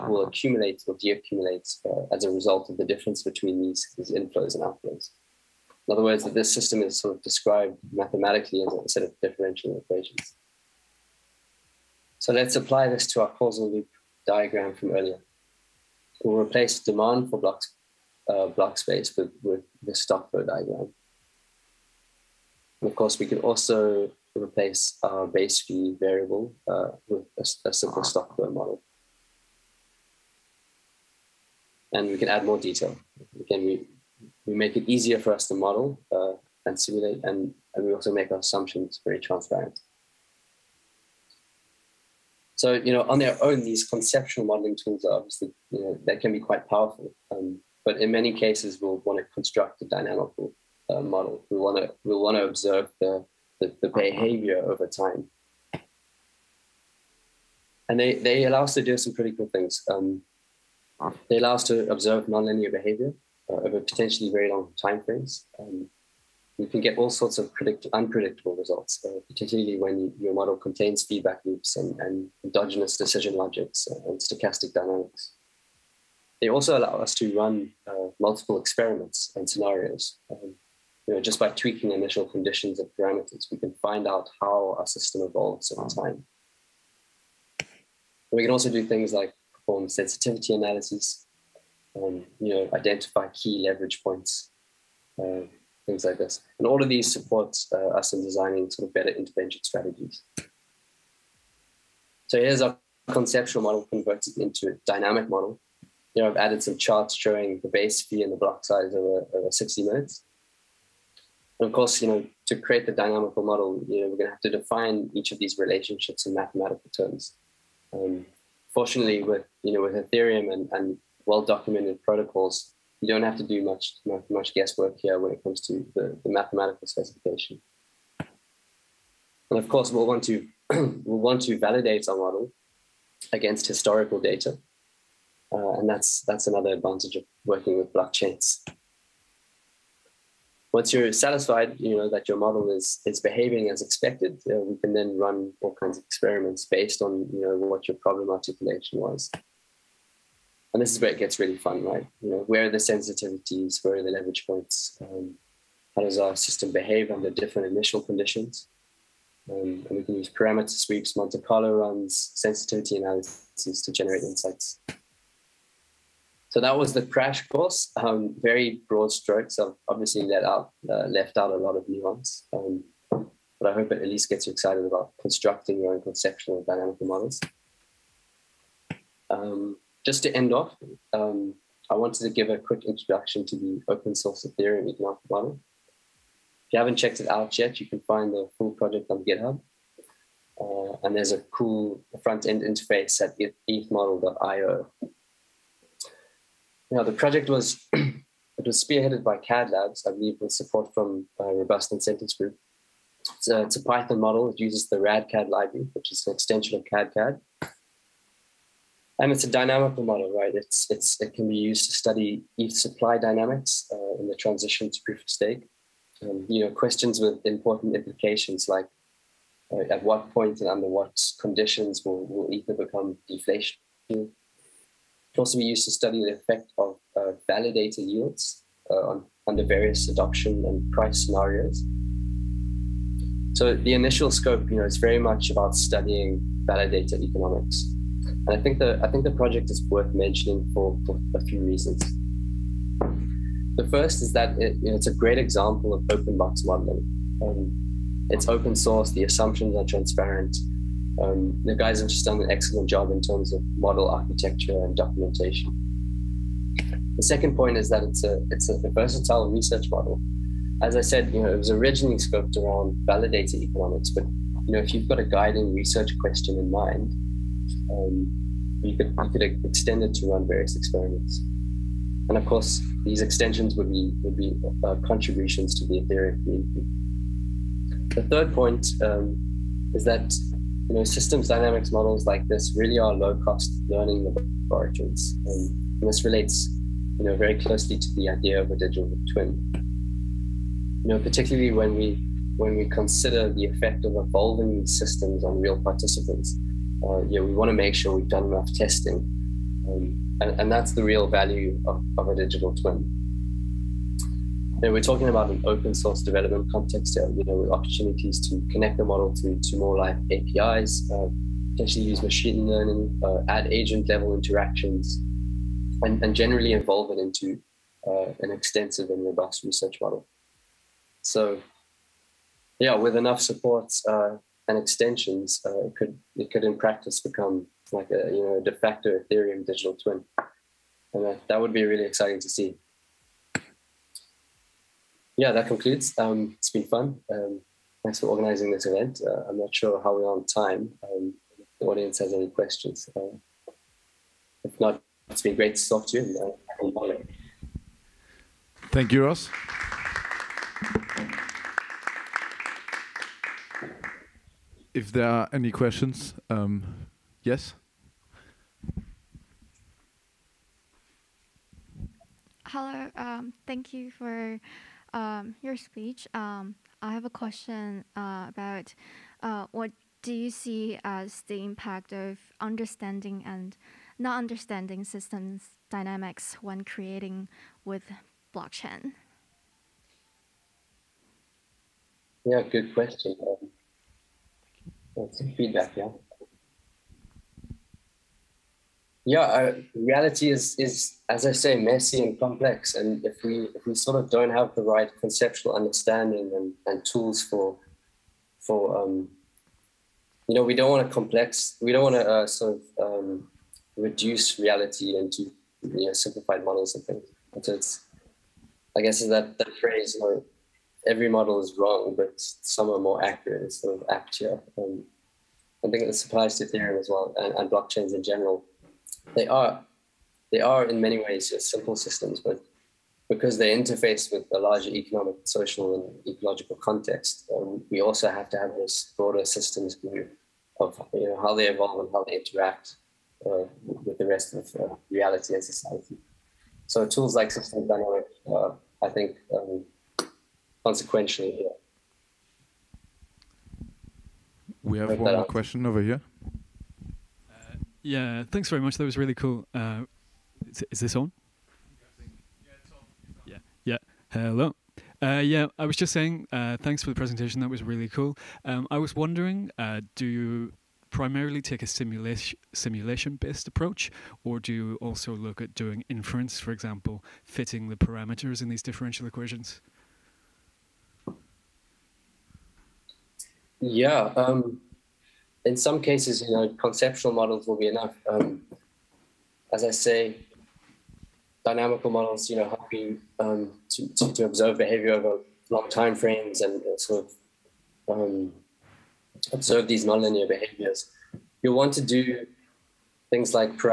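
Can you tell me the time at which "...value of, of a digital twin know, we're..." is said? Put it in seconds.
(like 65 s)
301 s.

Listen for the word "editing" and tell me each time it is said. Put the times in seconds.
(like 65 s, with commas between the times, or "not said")
not said.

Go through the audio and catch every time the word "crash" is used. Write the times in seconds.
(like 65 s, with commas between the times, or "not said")
167 s.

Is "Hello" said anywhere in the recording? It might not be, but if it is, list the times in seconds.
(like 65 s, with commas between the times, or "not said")
362 s, 454 s.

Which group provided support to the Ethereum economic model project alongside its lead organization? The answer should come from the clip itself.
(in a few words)
Robust Incentives Group.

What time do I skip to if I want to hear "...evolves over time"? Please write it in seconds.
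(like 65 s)
85 s.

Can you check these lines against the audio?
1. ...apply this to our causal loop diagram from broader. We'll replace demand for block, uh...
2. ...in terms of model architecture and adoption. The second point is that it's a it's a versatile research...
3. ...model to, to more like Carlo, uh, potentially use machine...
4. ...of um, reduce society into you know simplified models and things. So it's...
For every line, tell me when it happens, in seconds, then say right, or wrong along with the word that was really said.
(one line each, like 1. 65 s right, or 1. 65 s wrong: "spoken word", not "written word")
1. 12 s wrong: "earlier", not "broader"
2. 253 s wrong: "documentation", not "adoption"
3. 309 s wrong: "APIs", not "Carlo"
4. 402 s wrong: "reality", not "society".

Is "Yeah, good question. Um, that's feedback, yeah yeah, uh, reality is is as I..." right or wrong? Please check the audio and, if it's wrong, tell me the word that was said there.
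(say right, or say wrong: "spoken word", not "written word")
right.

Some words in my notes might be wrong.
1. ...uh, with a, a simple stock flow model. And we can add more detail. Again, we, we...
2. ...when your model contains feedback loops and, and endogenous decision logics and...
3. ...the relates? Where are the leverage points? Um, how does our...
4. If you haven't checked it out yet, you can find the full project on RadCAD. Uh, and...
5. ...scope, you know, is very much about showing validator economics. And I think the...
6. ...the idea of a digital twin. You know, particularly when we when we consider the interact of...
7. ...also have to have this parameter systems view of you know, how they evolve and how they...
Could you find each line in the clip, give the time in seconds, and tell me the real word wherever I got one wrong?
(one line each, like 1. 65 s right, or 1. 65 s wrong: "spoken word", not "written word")
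1. 26 s right
2. 69 s right
3. 152 s wrong: "sensitivities", not "relates"
4. 186 s wrong: "GitHub", not "RadCAD"
5. 234 s wrong: "studying", not "showing"
6. 288 s wrong: "effect", not "interact"
7. 428 s wrong: "broader", not "parameter".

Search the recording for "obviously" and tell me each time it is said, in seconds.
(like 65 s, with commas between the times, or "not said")
45 s, 169 s.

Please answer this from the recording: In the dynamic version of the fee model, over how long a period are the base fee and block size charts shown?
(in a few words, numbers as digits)
60 minutes.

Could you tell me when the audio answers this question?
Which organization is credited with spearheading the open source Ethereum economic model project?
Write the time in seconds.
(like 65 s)
199 s.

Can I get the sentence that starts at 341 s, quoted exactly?
Um, the audience has any questions.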